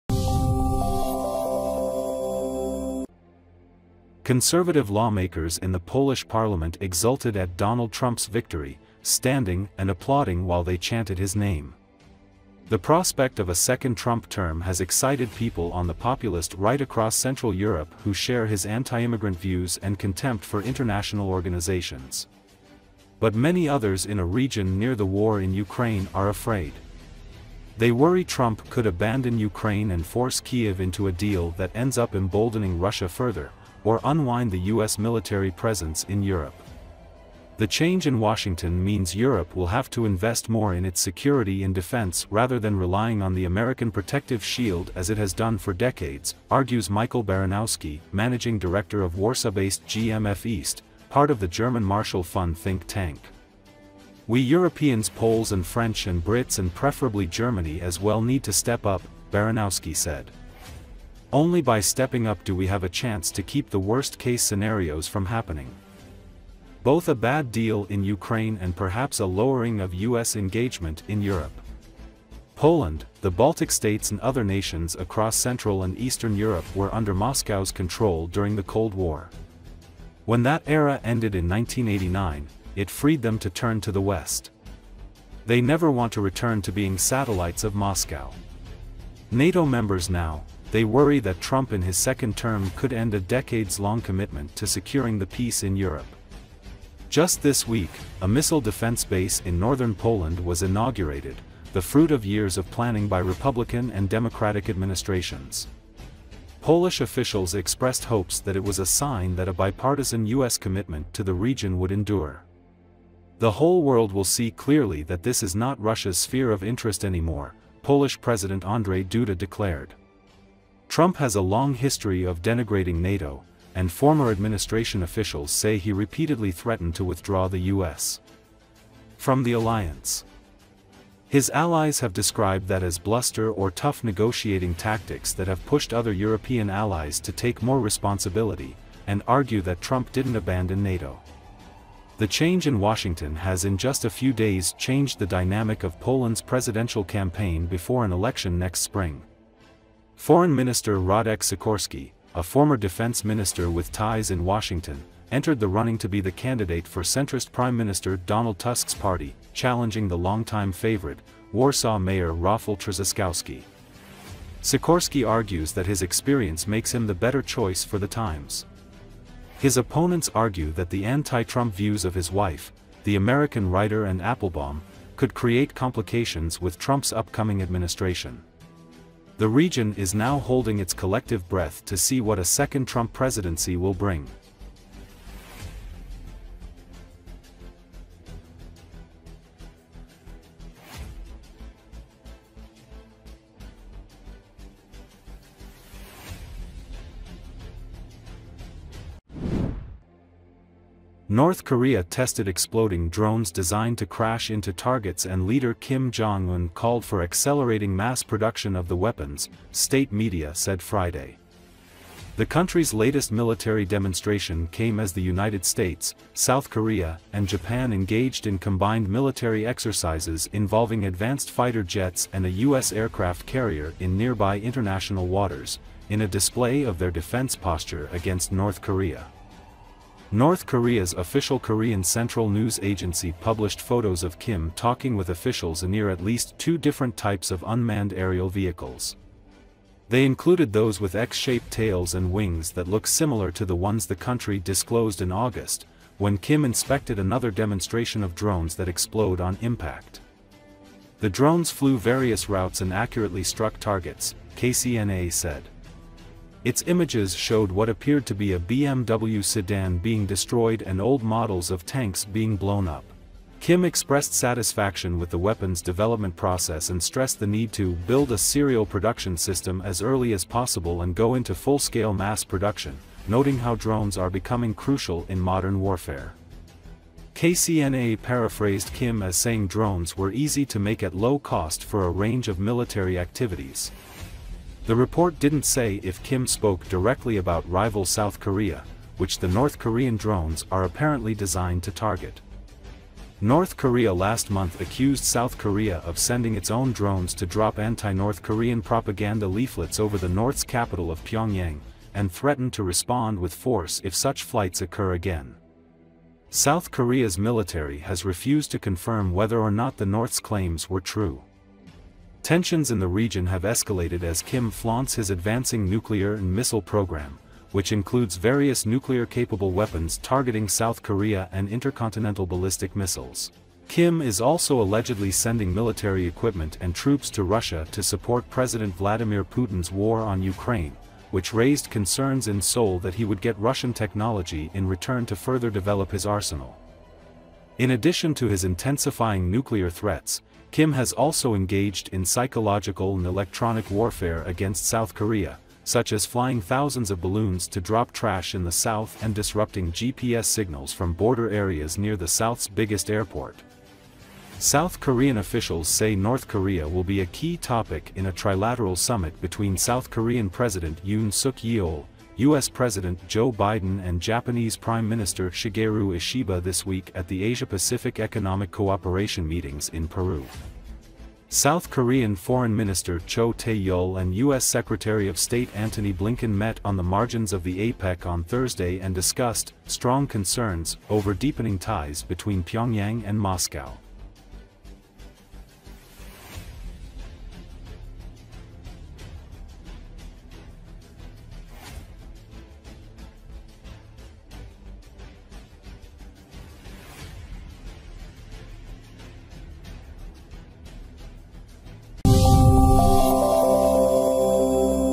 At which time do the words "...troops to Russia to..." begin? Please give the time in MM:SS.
05:26.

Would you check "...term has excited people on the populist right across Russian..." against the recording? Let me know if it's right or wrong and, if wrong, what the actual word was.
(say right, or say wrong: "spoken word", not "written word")
wrong: "Central", not "Russian".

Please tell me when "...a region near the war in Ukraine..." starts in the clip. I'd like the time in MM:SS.
00:24.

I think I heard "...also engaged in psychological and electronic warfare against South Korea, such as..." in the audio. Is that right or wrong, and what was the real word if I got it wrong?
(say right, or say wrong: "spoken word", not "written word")
right.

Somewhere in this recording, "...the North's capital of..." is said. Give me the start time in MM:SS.
05:00.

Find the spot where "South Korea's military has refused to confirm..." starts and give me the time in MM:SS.
05:06.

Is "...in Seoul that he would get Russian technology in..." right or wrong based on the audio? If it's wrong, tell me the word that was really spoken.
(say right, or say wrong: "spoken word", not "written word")
right.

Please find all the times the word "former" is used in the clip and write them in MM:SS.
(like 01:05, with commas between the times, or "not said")
02:03, 02:32.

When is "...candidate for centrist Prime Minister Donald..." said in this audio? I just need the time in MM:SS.
02:36.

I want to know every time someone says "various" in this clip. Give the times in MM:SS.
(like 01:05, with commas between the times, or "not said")
04:11, 05:18.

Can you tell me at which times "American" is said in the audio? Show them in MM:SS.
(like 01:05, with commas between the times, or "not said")
00:43, 02:53.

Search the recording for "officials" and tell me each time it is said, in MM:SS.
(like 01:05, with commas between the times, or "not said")
01:47, 02:05, 03:51, 03:55, 05:55.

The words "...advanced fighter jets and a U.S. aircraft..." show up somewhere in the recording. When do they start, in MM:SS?
03:41.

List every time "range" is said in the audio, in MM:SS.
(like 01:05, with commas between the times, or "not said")
04:42.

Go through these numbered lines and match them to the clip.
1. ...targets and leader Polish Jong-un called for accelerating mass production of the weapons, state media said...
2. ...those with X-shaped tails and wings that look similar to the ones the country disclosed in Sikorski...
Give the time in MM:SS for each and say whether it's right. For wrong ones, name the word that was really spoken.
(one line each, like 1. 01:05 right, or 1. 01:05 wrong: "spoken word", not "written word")
1. 03:24 wrong: "Kim", not "Polish"
2. 04:00 wrong: "August", not "Sikorski".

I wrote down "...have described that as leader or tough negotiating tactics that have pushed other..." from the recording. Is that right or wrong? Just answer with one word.
wrong.